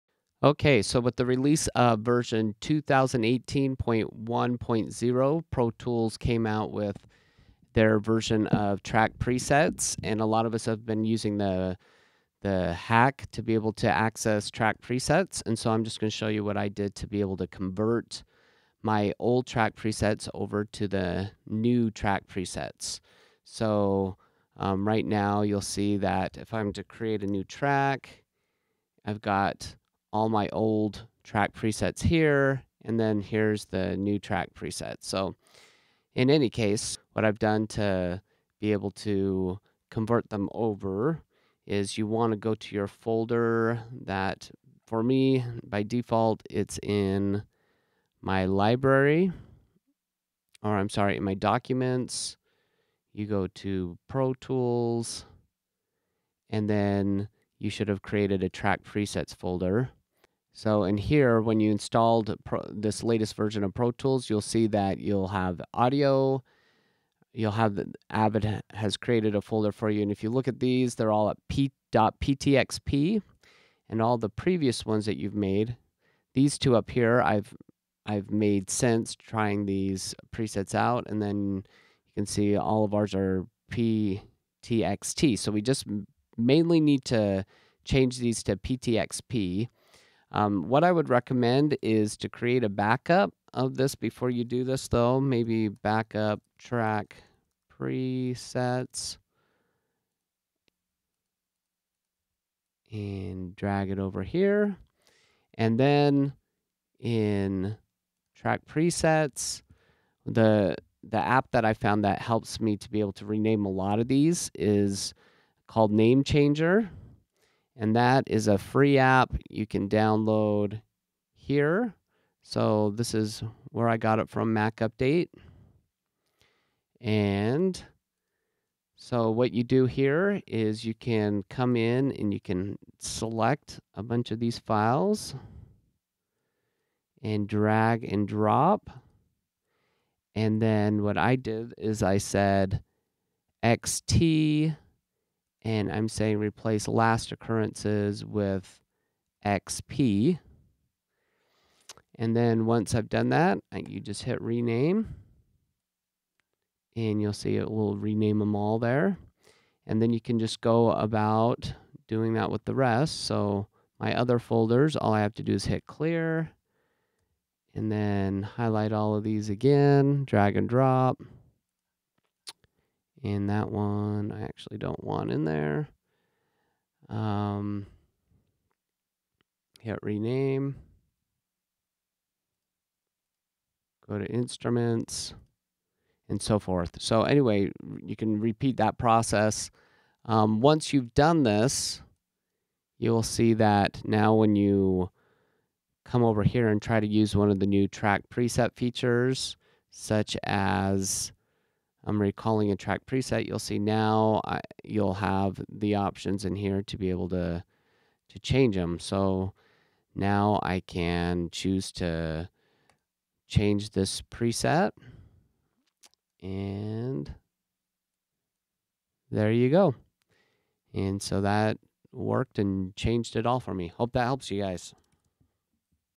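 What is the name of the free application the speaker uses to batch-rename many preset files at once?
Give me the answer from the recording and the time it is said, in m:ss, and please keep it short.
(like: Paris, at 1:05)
Name Changer, at 1:55.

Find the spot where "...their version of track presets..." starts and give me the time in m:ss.
0:07.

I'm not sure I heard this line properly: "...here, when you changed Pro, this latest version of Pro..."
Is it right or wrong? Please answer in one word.
wrong.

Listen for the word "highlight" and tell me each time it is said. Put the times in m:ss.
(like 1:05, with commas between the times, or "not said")
2:48.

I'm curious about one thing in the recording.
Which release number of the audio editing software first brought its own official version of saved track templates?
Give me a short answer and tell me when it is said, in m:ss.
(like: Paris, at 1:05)
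2018.1.0, at 0:02.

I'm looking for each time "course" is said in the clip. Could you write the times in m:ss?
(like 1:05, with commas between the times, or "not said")
not said.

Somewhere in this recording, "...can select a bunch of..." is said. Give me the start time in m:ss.
2:12.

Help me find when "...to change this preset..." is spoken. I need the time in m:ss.
3:31.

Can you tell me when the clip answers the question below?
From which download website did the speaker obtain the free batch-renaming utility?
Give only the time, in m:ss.
2:04.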